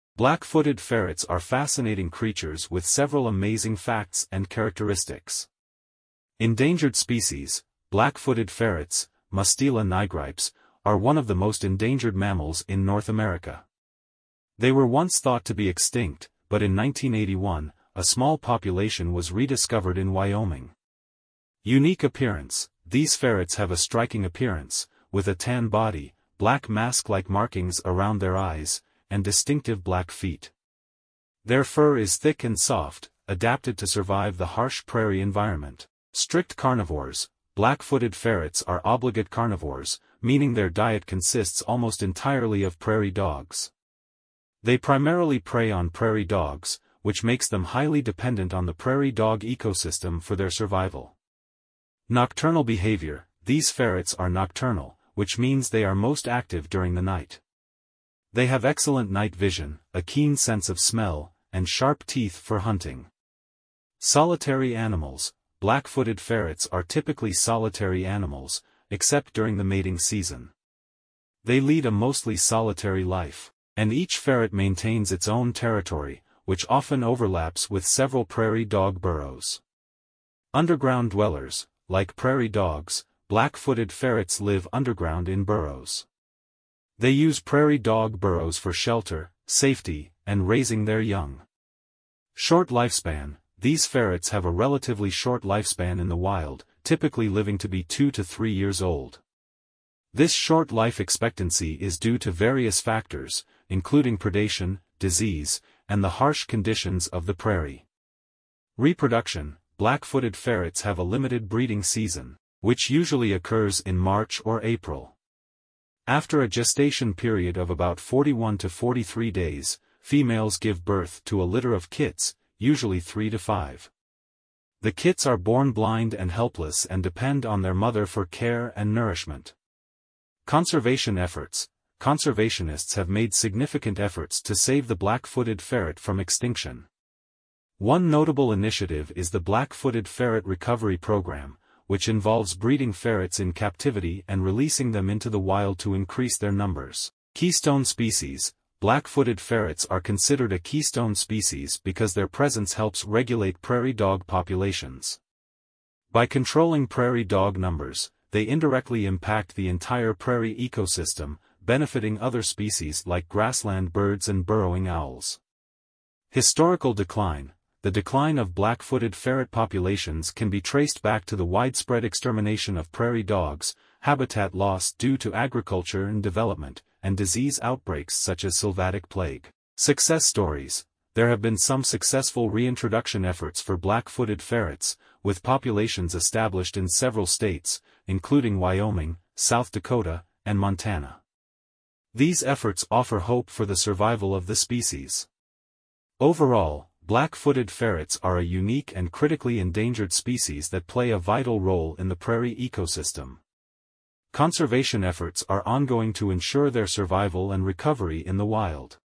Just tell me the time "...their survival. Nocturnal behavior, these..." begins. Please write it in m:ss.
0:50.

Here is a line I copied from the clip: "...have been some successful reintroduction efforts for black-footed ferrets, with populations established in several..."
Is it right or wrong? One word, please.
right.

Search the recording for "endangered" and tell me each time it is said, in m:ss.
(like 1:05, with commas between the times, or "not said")
0:06, 0:11, 3:19.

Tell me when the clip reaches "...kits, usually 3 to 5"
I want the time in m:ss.
2:01.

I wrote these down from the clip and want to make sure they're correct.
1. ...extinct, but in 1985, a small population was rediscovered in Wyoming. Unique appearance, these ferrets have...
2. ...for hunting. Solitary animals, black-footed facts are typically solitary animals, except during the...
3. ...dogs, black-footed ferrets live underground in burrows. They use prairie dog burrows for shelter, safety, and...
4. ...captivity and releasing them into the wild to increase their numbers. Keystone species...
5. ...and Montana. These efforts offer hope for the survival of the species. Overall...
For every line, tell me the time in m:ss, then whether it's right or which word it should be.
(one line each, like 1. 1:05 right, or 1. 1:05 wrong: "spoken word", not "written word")
1. 0:15 wrong: "1981", not "1985"
2. 1:02 wrong: "ferrets", not "facts"
3. 1:22 right
4. 2:23 right
5. 3:10 right.